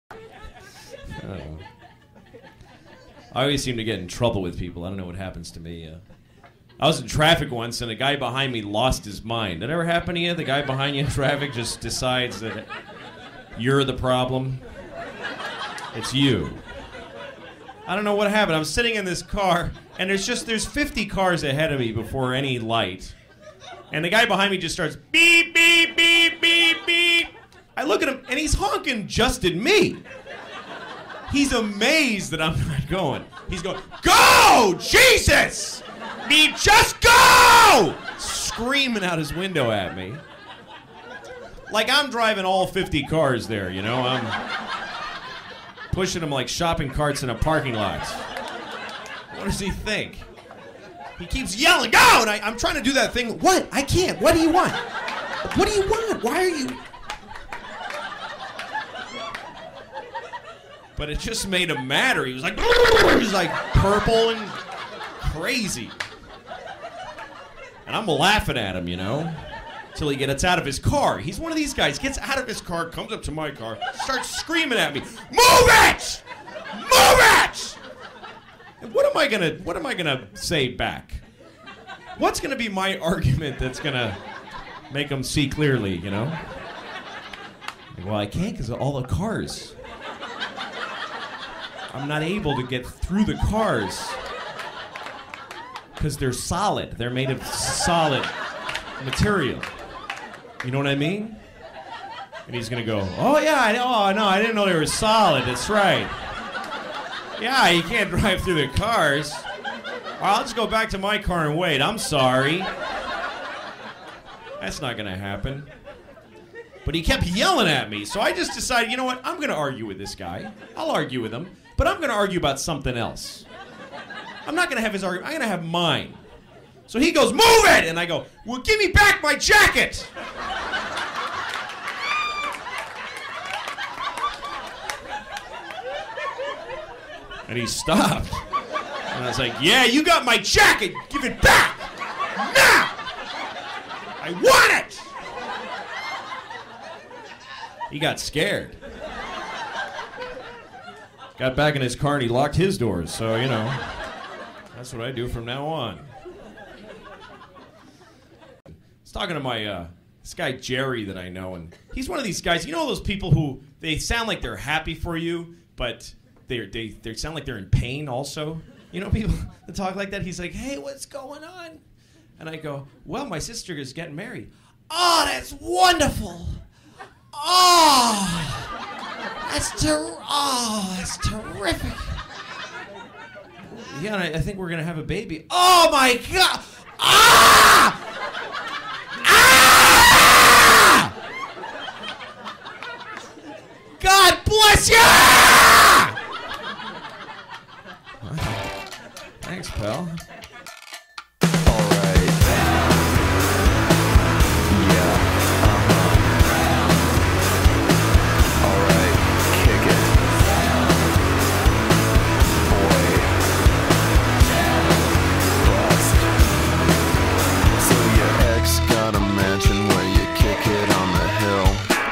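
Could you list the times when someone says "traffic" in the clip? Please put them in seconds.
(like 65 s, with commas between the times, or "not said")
7 s, 11 s.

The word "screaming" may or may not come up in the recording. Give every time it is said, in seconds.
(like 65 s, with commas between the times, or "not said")
38 s, 74 s.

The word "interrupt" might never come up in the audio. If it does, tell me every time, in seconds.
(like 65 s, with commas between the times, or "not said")
not said.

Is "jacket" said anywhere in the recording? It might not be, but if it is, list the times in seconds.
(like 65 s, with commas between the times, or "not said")
129 s, 140 s.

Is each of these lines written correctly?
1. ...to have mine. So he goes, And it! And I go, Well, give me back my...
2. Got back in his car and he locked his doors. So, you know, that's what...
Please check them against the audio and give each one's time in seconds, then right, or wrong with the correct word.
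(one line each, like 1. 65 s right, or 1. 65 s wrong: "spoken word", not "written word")
1. 125 s wrong: "Move", not "And"
2. 151 s right.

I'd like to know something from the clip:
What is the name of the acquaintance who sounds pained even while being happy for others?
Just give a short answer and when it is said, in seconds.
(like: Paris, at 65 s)
Jerry, at 160 s.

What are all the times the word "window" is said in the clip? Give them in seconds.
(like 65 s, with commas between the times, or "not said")
39 s.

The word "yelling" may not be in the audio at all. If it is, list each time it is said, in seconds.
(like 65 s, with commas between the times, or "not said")
51 s, 117 s.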